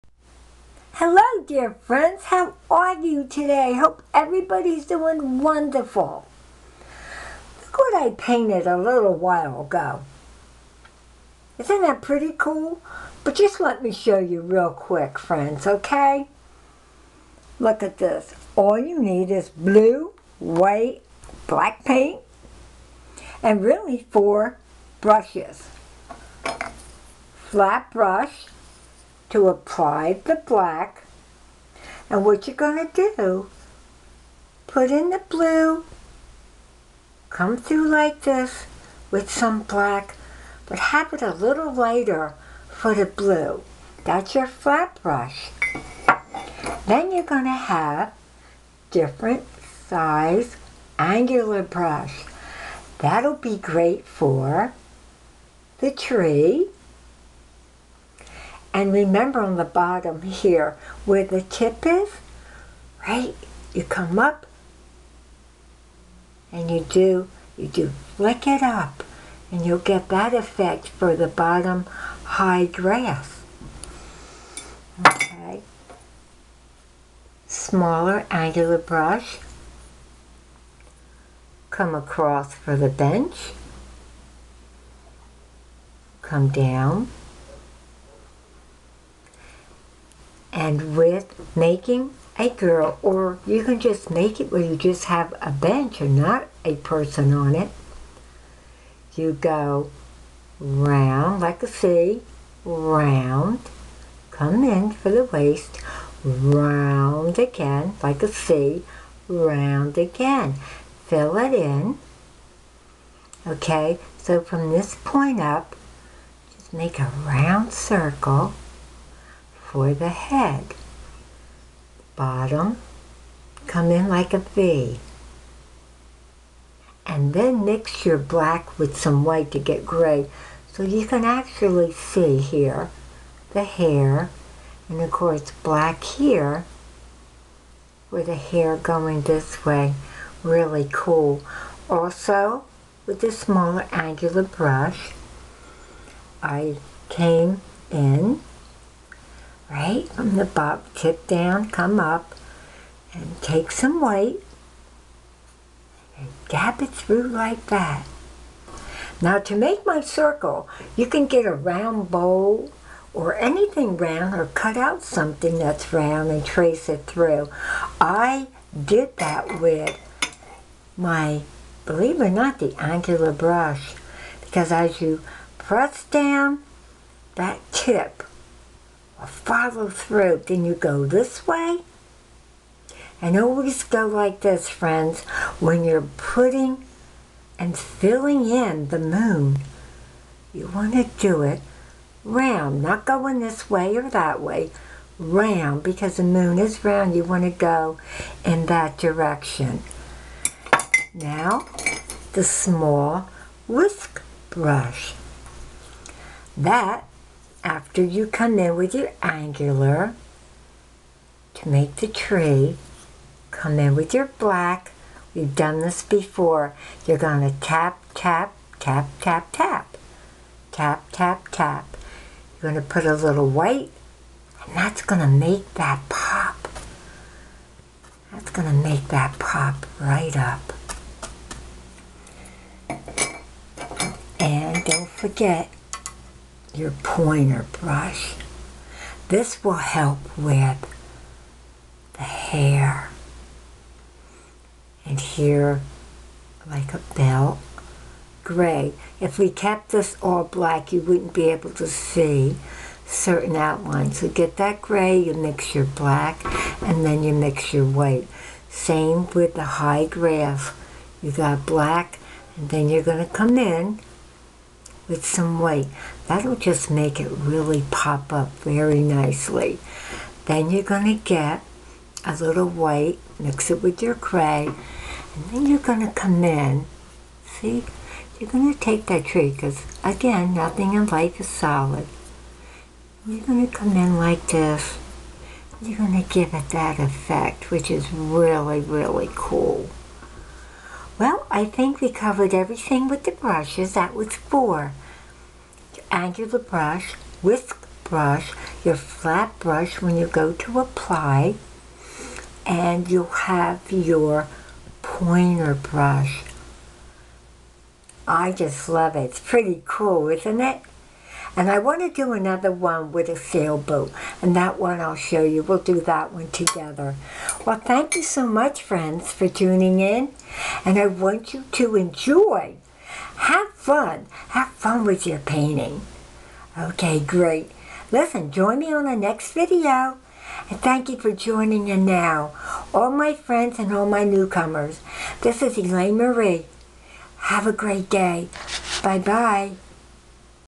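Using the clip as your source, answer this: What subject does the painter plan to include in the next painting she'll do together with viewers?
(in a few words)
A sailboat.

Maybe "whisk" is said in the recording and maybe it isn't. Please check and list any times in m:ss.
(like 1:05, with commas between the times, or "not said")
3:23, 4:57.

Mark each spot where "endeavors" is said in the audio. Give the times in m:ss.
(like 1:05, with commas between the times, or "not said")
not said.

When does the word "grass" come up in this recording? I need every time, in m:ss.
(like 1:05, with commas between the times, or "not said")
1:12, 4:20.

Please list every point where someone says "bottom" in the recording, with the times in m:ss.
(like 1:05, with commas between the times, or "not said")
0:59, 1:11, 2:02.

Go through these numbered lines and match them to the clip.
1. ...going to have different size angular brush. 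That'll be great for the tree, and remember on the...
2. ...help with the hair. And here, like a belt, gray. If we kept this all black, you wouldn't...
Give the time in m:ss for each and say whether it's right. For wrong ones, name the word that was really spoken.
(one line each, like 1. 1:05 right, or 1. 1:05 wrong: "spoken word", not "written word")
1. 0:47 right
2. 3:59 right.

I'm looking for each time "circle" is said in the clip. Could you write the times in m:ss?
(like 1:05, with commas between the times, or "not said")
1:57, 2:40.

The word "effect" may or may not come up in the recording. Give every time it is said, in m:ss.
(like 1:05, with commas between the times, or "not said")
1:10, 4:46.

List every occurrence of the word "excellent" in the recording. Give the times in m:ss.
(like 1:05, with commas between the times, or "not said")
not said.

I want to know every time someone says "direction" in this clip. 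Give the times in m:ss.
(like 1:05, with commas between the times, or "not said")
3:18.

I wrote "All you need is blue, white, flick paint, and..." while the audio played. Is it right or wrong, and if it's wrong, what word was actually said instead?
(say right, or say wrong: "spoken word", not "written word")
wrong: "black", not "flick".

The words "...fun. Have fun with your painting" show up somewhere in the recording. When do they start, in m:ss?
5:23.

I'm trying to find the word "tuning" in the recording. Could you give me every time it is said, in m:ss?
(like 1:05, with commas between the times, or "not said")
5:19.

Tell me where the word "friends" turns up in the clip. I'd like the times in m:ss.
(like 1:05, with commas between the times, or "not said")
0:01, 0:15, 3:04, 5:18, 5:33.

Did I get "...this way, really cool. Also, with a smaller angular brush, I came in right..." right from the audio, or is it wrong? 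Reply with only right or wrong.
right.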